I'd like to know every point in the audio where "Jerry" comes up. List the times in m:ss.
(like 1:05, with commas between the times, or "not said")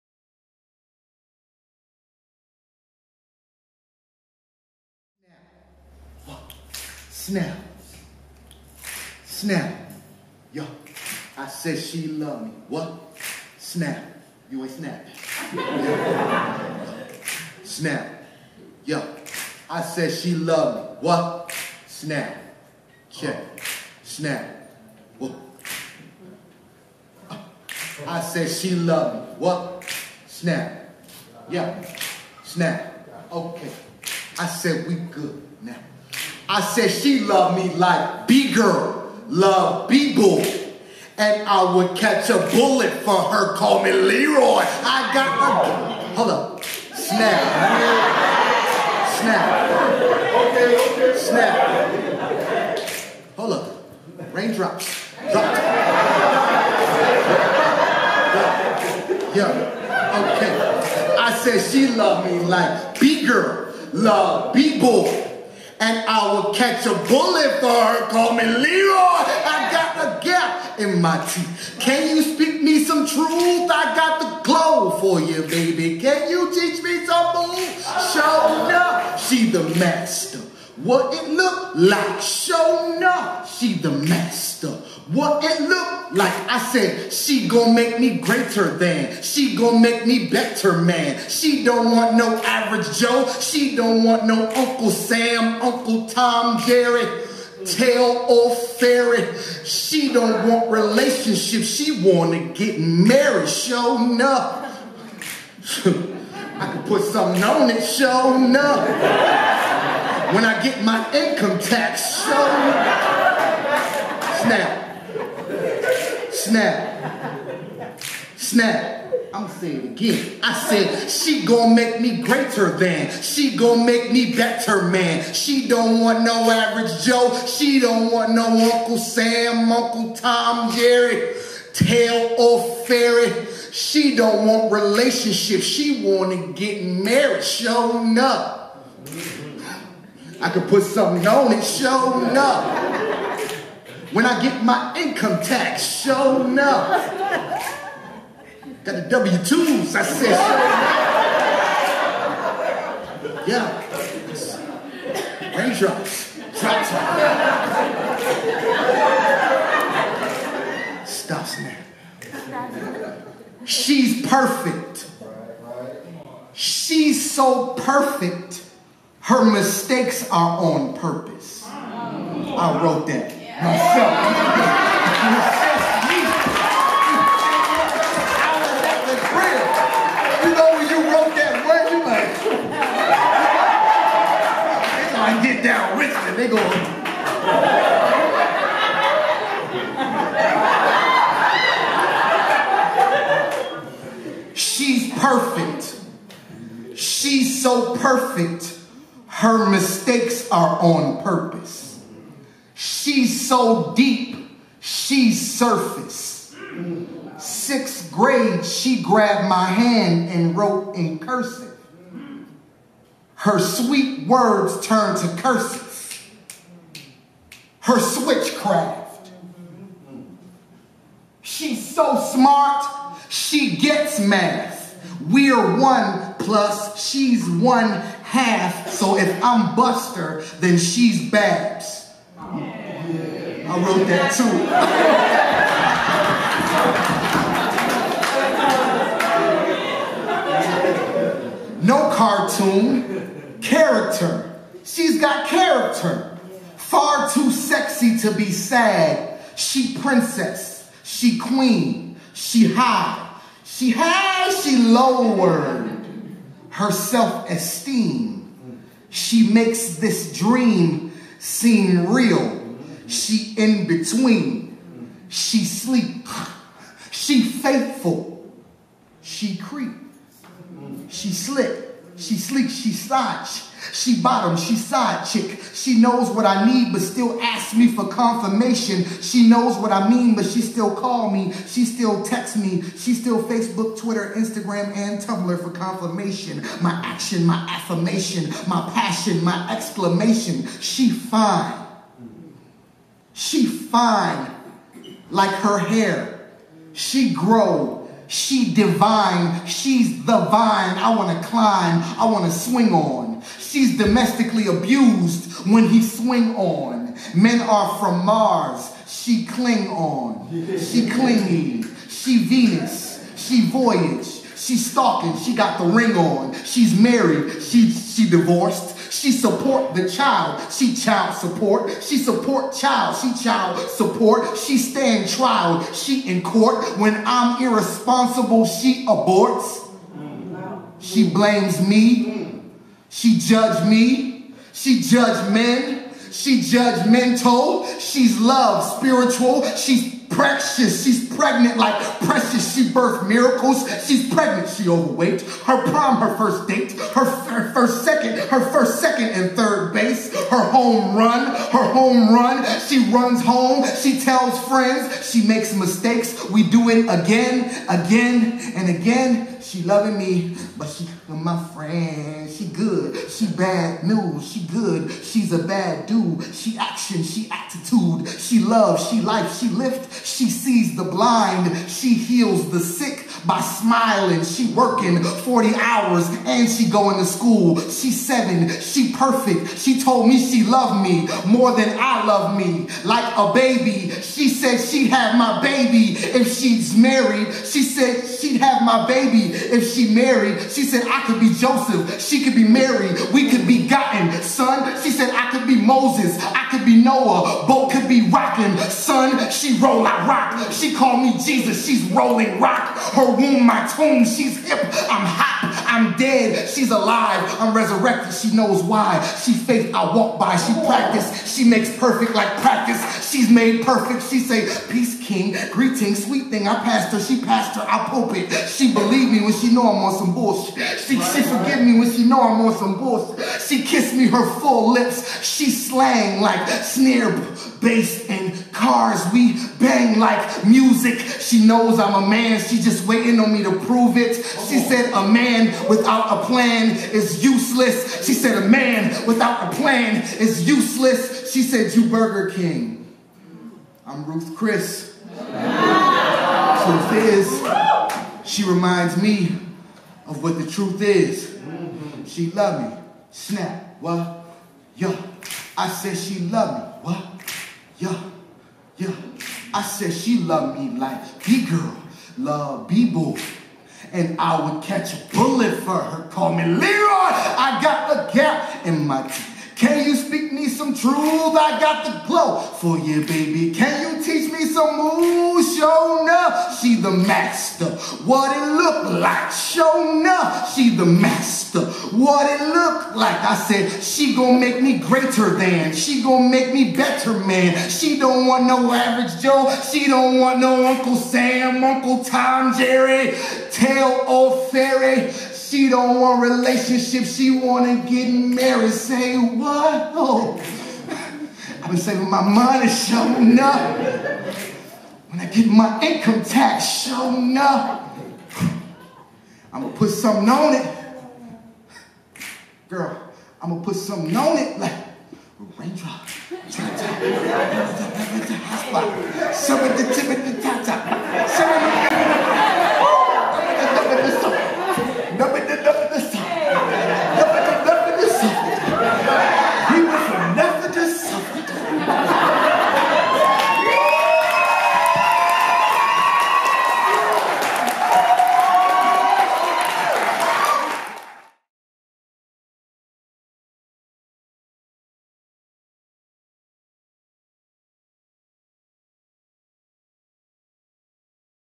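1:36, 2:10, 8:12.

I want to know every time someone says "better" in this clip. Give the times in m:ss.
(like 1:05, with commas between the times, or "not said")
1:30, 2:04, 8:06.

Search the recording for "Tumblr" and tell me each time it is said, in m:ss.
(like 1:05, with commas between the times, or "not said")
4:45.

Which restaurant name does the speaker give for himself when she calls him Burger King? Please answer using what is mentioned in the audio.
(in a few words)
Ruth's Chris.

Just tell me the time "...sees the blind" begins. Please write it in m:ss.
6:10.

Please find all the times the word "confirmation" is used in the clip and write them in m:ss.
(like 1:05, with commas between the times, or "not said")
4:38, 4:45.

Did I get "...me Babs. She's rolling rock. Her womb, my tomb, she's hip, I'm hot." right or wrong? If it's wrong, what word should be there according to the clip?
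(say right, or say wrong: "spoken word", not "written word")
wrong: "Jesus", not "Babs".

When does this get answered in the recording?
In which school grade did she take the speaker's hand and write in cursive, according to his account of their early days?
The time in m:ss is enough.
3:27.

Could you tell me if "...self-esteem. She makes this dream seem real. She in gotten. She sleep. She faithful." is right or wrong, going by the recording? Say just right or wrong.
wrong.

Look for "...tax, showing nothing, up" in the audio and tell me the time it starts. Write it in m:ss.
8:26.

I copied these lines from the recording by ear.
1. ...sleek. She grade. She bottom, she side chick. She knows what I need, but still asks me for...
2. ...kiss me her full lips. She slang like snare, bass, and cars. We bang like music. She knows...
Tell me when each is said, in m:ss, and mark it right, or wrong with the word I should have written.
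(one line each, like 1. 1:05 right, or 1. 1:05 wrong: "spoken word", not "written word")
1. 4:32 wrong: "slide", not "grade"
2. 7:03 right.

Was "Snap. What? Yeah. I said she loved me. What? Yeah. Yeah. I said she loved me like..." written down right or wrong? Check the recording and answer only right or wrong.
right.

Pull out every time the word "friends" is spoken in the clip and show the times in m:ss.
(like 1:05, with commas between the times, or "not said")
5:54, 6:01.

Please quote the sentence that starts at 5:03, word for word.
She's domestically abused when he swing on.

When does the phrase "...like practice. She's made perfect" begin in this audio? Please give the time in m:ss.
6:52.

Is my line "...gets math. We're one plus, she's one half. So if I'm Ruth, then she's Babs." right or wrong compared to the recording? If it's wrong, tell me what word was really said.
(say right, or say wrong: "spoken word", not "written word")
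wrong: "Buster", not "Ruth".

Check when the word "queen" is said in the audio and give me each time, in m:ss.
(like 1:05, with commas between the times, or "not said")
4:11.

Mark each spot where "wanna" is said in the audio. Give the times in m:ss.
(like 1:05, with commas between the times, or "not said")
1:42, 2:16.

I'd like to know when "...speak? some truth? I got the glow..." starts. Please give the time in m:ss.
7:50.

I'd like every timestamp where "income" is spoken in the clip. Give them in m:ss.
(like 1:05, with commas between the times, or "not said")
1:51, 2:24, 8:26.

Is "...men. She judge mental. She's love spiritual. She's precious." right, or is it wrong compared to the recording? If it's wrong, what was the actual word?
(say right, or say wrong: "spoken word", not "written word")
right.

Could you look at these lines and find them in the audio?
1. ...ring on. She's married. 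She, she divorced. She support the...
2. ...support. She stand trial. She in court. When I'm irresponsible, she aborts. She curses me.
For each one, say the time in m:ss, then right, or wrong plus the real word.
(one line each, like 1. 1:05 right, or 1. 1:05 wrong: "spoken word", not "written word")
1. 5:15 right
2. 5:23 wrong: "blames", not "curses".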